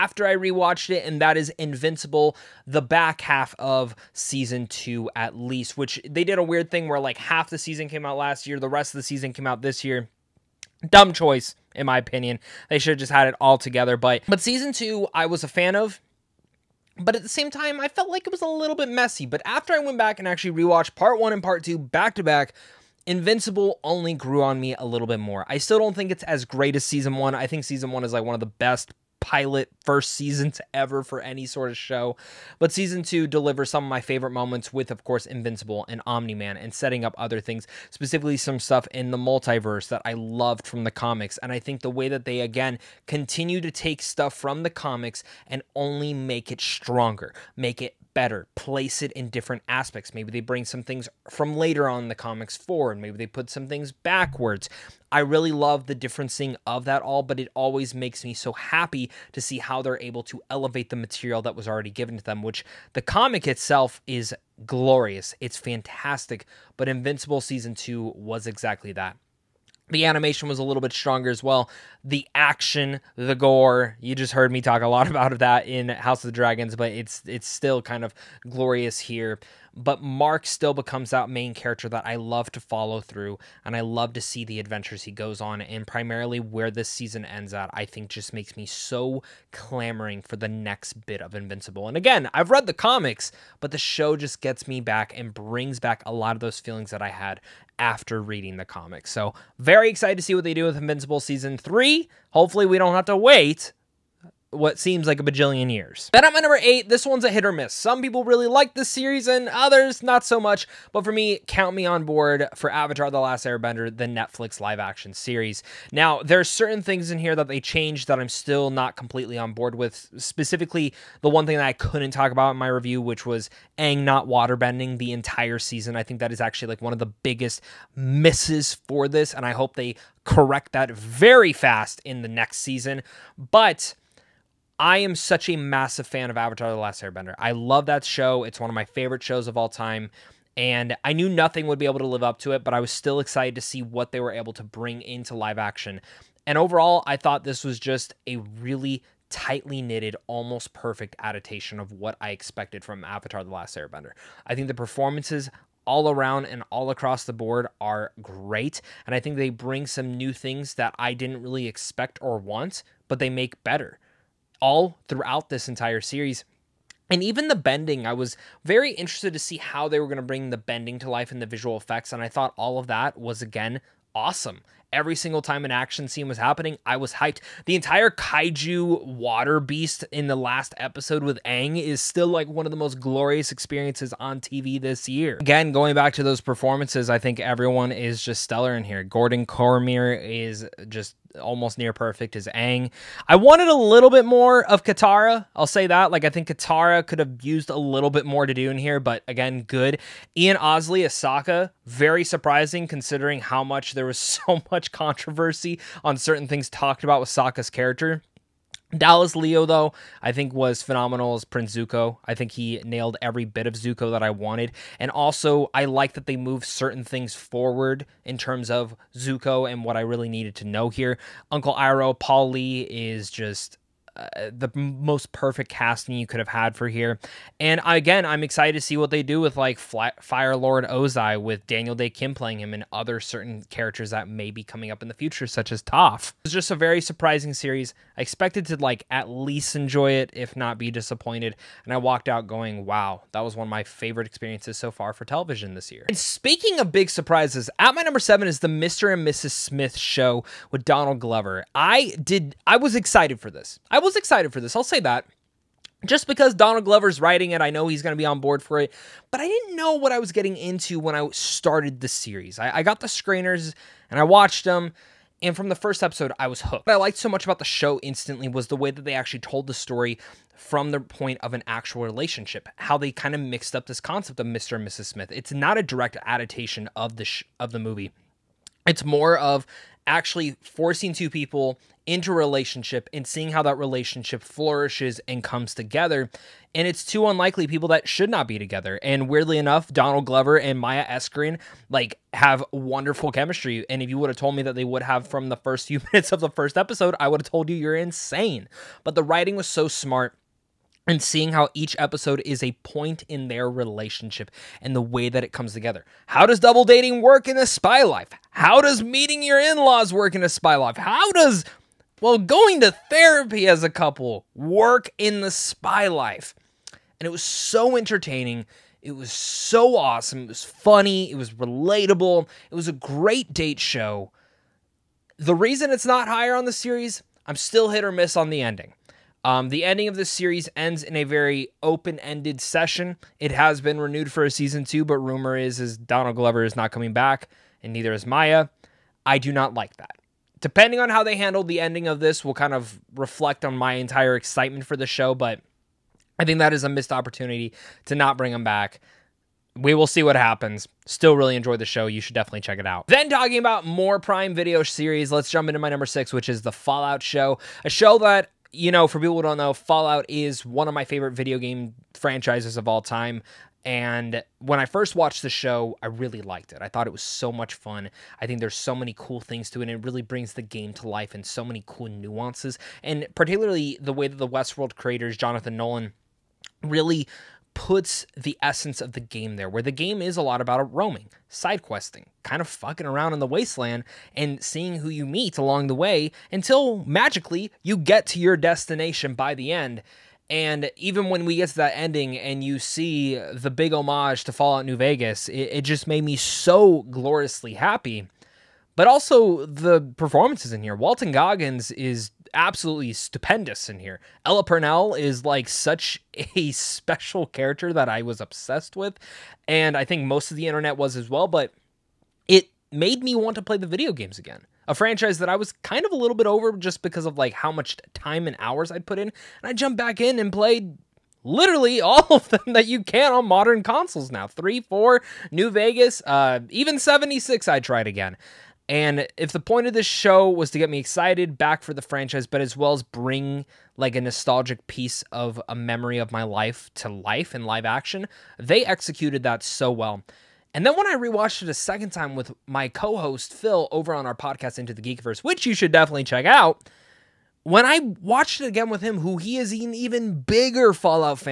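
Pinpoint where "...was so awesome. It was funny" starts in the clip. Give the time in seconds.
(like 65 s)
319 s.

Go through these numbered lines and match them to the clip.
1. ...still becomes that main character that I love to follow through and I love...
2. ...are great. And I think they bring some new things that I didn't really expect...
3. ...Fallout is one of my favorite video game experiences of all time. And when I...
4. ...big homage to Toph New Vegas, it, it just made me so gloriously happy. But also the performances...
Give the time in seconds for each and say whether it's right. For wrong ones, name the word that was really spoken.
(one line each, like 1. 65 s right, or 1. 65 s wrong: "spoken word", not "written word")
1. 80 s right
2. 157 s right
3. 359 s wrong: "franchises", not "experiences"
4. 393 s wrong: "Fallout", not "Toph".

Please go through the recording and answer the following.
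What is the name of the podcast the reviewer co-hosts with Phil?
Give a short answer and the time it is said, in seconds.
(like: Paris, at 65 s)
Into the Geekverse, at 444 s.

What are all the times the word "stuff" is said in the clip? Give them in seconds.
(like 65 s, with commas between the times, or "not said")
38 s, 44 s.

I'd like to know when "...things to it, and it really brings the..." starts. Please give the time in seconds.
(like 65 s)
369 s.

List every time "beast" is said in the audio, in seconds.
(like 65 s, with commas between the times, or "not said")
179 s.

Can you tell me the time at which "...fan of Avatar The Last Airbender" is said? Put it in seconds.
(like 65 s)
136 s.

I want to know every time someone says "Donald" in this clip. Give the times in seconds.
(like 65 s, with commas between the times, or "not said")
250 s, 256 s, 289 s, 335 s.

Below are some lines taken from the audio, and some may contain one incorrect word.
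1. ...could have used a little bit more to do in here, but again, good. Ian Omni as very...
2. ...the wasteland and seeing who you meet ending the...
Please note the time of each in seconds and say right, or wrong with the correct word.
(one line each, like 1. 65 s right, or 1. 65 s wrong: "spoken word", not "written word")
1. 197 s wrong: "Ousley", not "Omni"
2. 383 s wrong: "along", not "ending".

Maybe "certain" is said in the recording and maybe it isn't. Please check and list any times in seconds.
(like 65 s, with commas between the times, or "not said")
116 s, 206 s, 216 s, 233 s.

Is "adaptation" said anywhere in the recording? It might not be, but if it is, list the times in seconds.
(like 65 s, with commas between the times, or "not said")
151 s, 276 s.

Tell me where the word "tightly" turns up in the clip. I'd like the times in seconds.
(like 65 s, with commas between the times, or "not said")
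149 s.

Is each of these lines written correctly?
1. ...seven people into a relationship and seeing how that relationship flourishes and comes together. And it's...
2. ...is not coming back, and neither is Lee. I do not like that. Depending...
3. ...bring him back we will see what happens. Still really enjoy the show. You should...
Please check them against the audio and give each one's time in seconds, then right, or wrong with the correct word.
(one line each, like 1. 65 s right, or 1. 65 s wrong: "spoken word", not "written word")
1. 281 s wrong: "two", not "seven"
2. 336 s wrong: "Maya", not "Lee"
3. 348 s right.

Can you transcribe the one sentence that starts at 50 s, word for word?
Maybe they bring some things from later on in the comics forward, maybe they put some things backwards.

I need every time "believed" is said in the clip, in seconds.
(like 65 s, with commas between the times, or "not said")
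not said.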